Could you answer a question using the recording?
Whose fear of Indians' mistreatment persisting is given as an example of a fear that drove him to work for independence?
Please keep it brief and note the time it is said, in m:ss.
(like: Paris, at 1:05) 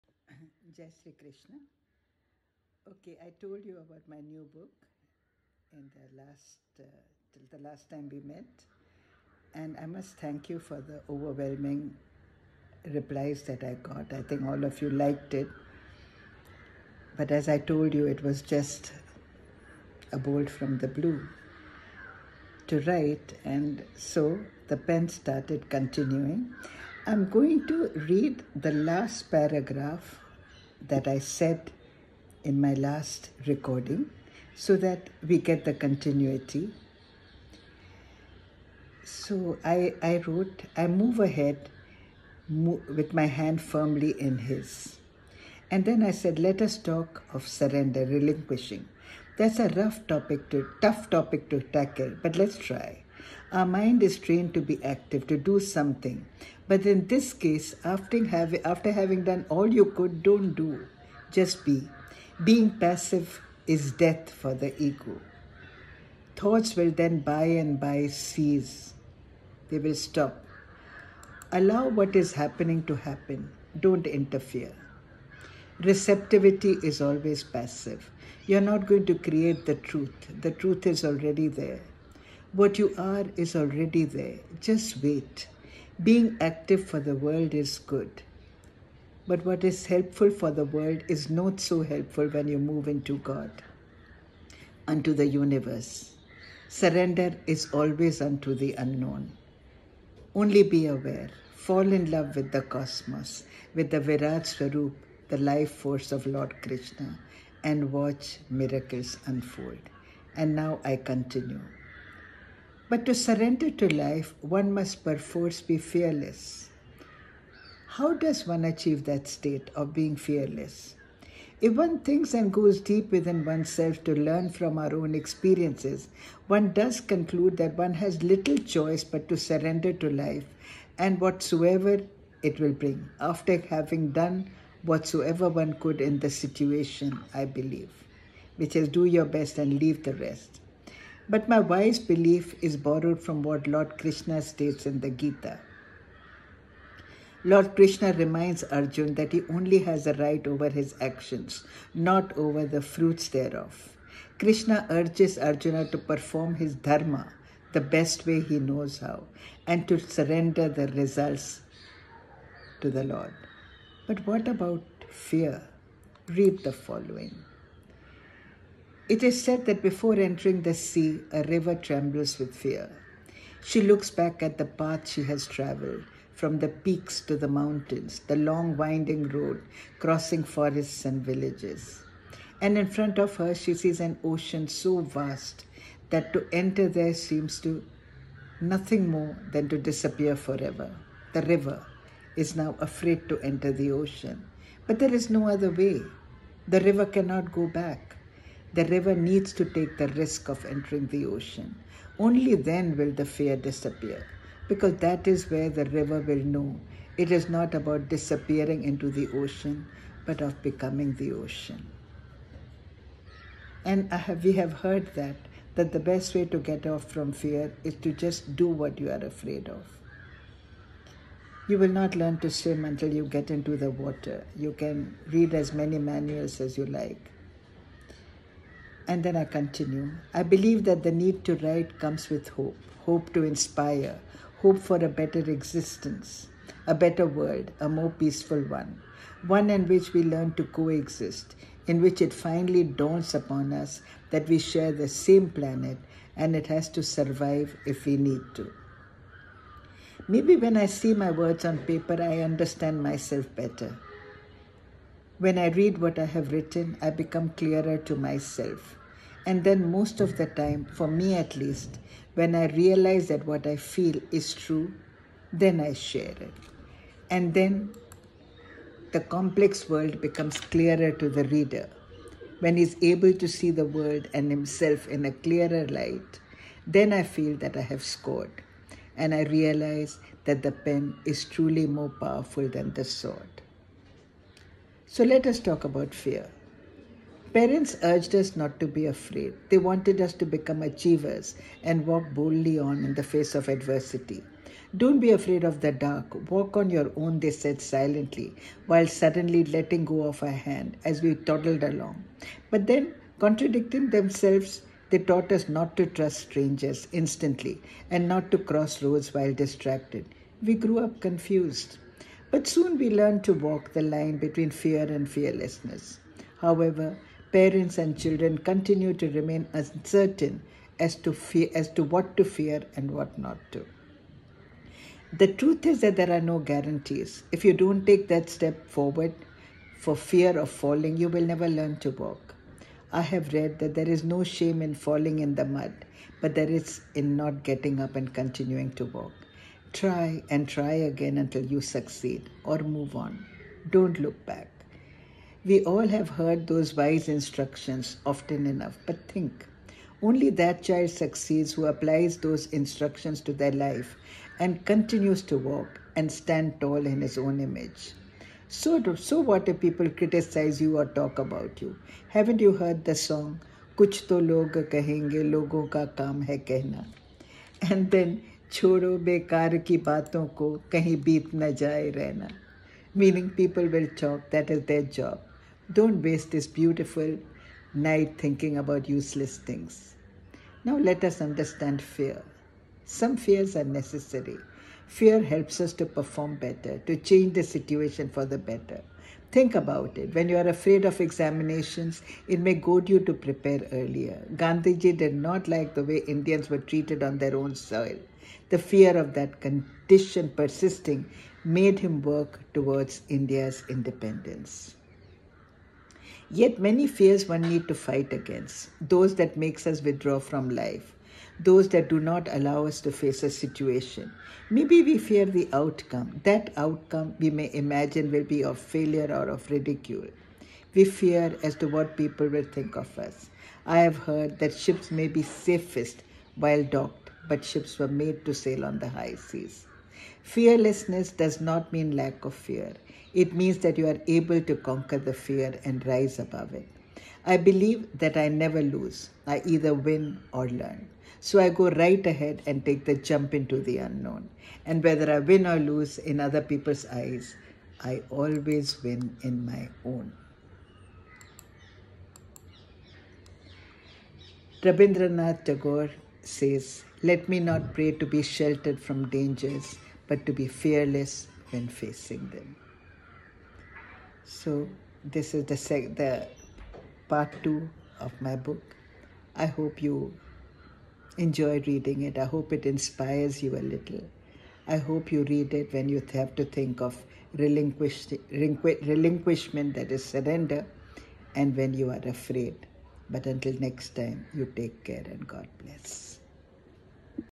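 Gandhiji, at 6:34.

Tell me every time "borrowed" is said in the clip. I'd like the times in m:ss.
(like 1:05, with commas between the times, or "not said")
2:22.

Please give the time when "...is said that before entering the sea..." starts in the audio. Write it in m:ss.
2:49.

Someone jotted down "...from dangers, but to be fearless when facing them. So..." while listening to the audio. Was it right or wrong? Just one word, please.
right.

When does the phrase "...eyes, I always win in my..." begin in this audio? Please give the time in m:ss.
7:27.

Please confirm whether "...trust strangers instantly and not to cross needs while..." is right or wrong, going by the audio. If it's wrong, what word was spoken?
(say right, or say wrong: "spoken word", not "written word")
wrong: "roads", not "needs".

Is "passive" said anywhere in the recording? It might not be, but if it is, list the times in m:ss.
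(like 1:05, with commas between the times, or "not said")
1:02, 1:17.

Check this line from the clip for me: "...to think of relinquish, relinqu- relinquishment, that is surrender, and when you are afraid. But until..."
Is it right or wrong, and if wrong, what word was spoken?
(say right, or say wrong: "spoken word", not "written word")
right.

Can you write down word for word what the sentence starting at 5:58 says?
So, so what if people criticize you or talk about you?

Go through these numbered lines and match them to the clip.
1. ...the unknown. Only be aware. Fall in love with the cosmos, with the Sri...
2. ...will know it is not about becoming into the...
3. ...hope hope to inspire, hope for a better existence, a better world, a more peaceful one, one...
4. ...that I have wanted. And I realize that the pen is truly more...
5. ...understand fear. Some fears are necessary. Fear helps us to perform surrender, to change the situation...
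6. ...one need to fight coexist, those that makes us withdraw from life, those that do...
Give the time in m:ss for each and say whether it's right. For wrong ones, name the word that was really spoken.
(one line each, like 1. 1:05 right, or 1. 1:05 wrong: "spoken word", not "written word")
1. 1:38 wrong: "Virat", not "Sri"
2. 3:26 wrong: "disappearing", not "becoming"
3. 3:52 right
4. 4:37 wrong: "scored", not "wanted"
5. 6:21 wrong: "better", not "surrender"
6. 6:47 wrong: "against", not "coexist".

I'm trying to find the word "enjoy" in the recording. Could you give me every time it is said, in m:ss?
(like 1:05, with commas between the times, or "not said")
7:51.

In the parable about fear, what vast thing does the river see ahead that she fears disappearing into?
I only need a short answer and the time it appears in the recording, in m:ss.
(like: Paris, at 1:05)
an ocean, at 3:03.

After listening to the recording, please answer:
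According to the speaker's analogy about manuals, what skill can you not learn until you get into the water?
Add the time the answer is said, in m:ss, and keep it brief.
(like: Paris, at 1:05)
to swim, at 3:42.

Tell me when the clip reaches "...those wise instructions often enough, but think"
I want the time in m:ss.
5:46.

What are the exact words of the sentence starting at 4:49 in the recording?
They wanted us to become achievers and walk boldly on in the face of adversity.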